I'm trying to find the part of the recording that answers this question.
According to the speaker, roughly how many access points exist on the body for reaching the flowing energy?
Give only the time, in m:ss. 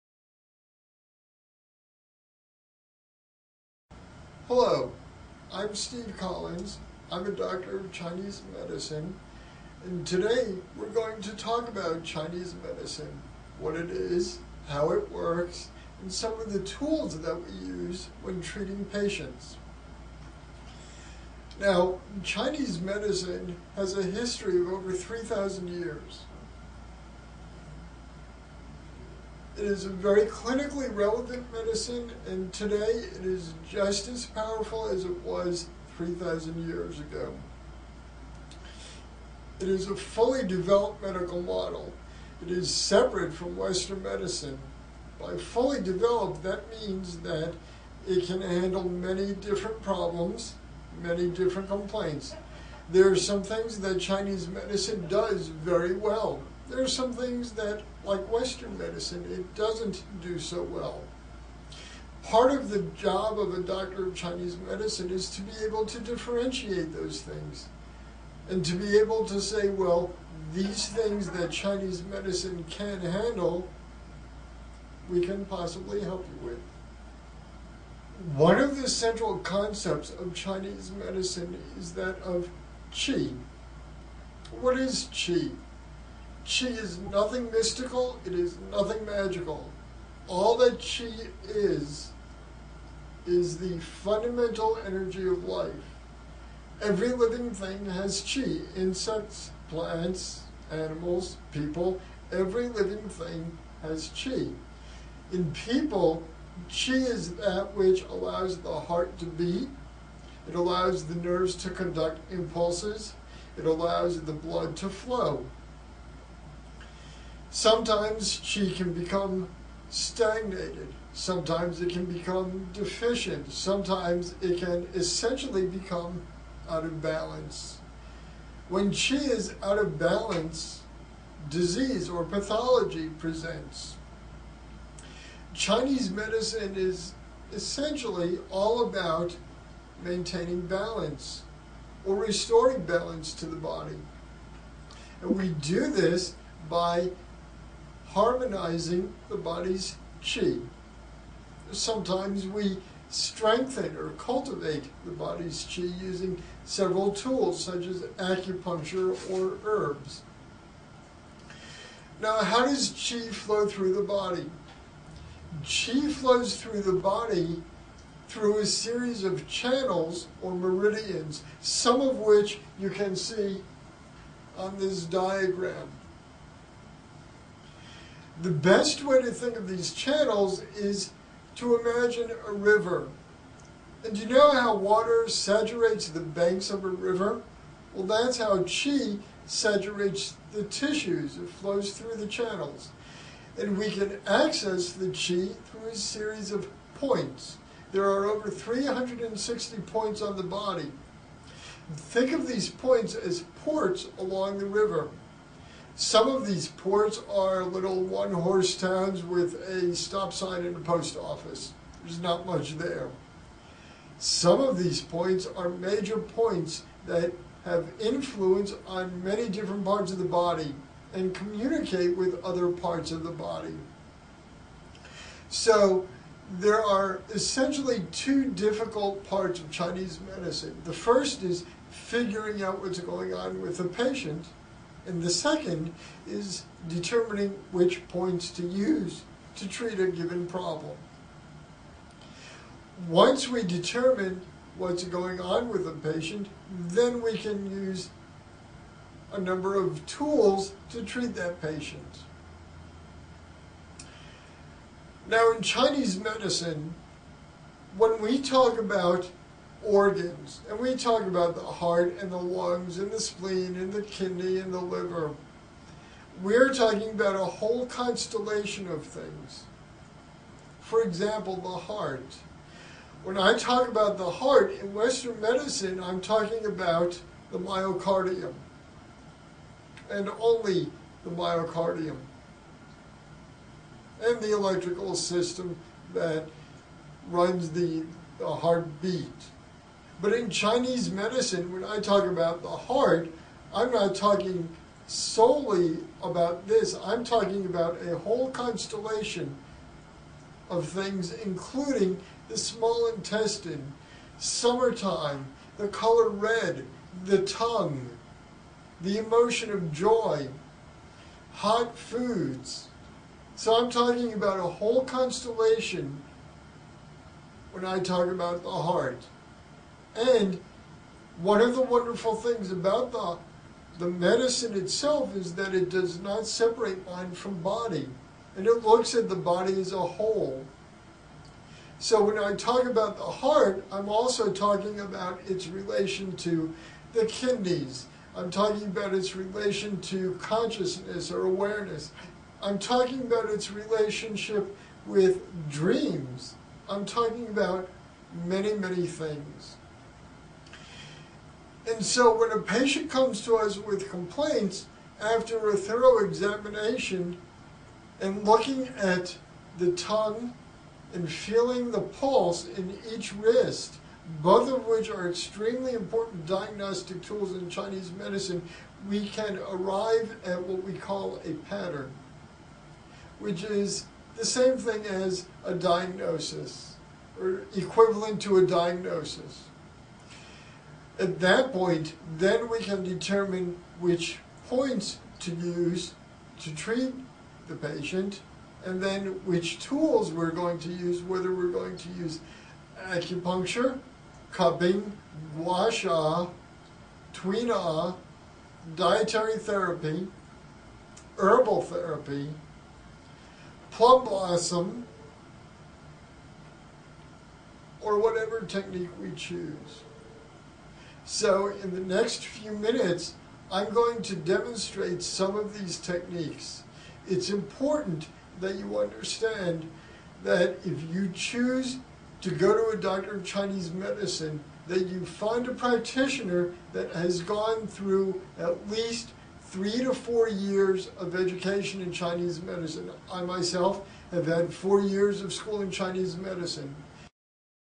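3:18.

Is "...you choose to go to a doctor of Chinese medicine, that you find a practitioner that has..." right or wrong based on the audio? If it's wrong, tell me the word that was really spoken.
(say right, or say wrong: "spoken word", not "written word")
right.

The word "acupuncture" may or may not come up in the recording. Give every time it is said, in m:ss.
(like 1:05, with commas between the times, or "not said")
2:38, 6:33.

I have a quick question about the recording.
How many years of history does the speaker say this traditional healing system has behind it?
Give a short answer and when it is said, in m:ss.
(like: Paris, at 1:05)
over 3,000 years, at 0:24.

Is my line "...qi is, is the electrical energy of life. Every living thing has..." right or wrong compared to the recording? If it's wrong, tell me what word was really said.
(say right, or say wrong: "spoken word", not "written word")
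wrong: "fundamental", not "electrical".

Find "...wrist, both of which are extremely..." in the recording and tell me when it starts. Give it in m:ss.
6:03.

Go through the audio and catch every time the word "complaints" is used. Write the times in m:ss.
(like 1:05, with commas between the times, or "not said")
0:51, 5:54.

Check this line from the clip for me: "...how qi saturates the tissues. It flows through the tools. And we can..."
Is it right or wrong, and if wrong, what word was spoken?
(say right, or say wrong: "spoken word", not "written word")
wrong: "channels", not "tools".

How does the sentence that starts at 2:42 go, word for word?
Now, how does qi flow through the body?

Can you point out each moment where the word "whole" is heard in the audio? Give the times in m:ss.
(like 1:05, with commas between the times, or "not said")
4:27, 4:58, 5:14, 5:29.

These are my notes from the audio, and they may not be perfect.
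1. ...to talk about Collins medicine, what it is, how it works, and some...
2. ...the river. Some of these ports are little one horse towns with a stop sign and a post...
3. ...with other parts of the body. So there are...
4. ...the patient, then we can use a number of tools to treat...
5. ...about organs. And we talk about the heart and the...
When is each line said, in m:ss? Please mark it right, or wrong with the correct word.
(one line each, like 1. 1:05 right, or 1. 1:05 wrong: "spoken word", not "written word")
1. 0:11 wrong: "Chinese", not "Collins"
2. 3:24 right
3. 3:42 right
4. 4:05 right
5. 4:18 right.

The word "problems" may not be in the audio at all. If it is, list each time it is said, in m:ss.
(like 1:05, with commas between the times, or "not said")
0:49, 4:00.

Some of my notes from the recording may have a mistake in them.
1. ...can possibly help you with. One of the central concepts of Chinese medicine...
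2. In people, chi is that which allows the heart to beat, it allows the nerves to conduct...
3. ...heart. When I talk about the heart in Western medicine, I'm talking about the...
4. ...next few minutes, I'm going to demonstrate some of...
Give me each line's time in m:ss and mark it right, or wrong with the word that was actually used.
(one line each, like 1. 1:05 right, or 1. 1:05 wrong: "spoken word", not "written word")
1. 1:15 right
2. 1:45 right
3. 4:31 right
4. 6:52 right.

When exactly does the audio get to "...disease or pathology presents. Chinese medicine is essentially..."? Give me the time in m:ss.
2:11.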